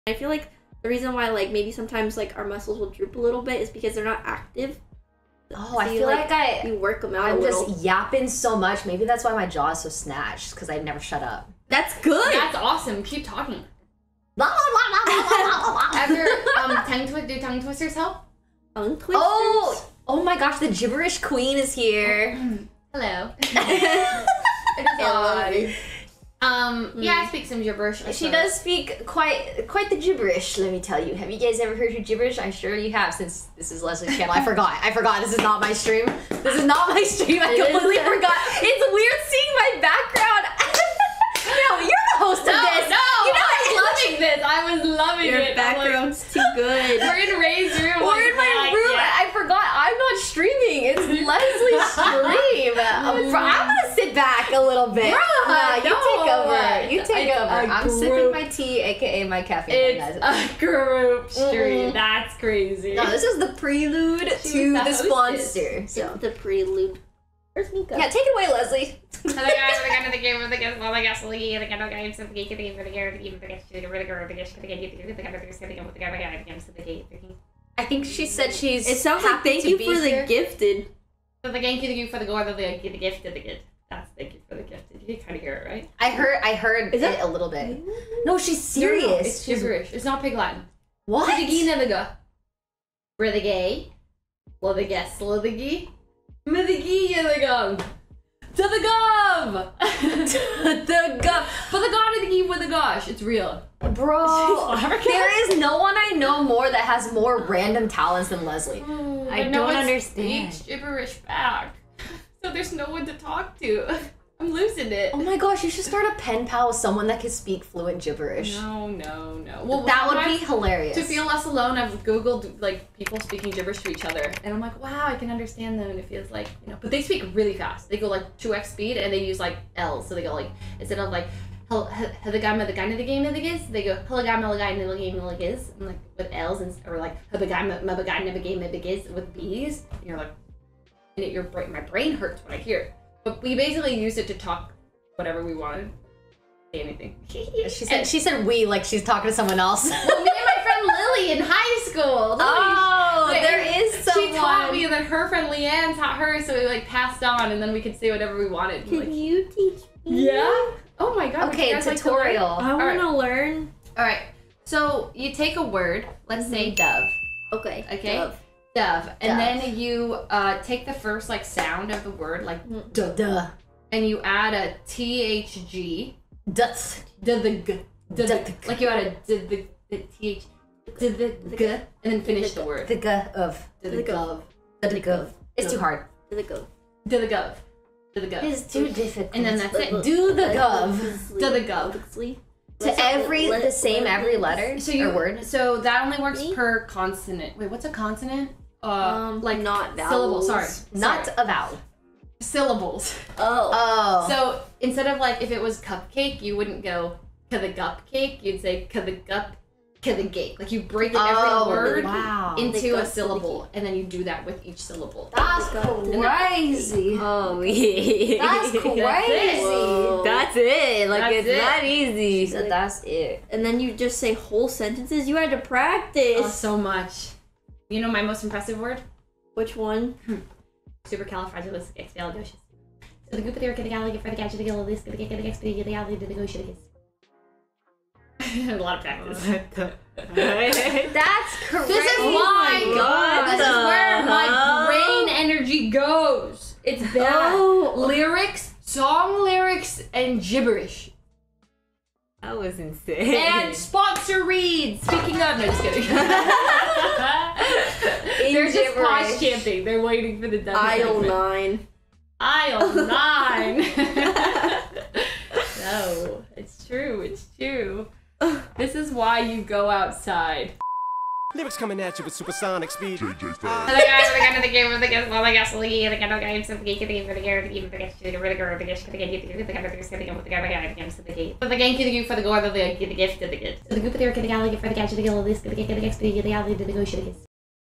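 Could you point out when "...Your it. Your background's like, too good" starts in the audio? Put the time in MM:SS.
00:45.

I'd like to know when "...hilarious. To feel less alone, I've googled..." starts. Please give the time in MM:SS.
02:00.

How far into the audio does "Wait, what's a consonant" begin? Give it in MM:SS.
03:17.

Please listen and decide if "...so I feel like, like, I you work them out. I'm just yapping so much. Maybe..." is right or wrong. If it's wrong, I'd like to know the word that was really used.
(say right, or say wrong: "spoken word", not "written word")
right.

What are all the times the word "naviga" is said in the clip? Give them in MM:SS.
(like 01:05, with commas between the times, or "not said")
01:31.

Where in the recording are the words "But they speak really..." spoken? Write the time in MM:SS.
02:06.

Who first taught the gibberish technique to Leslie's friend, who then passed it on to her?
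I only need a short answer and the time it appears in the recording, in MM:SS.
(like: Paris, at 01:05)
Leanne, at 02:35.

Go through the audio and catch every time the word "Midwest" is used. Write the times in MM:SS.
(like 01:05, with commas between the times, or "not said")
not said.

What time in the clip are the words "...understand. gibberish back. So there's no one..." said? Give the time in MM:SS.
01:49.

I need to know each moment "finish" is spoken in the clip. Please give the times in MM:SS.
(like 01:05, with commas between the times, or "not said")
03:02.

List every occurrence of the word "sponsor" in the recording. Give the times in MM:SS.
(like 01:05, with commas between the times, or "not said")
01:04, 04:13.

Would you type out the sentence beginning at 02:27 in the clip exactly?
And, she said we like she's talking to someone else.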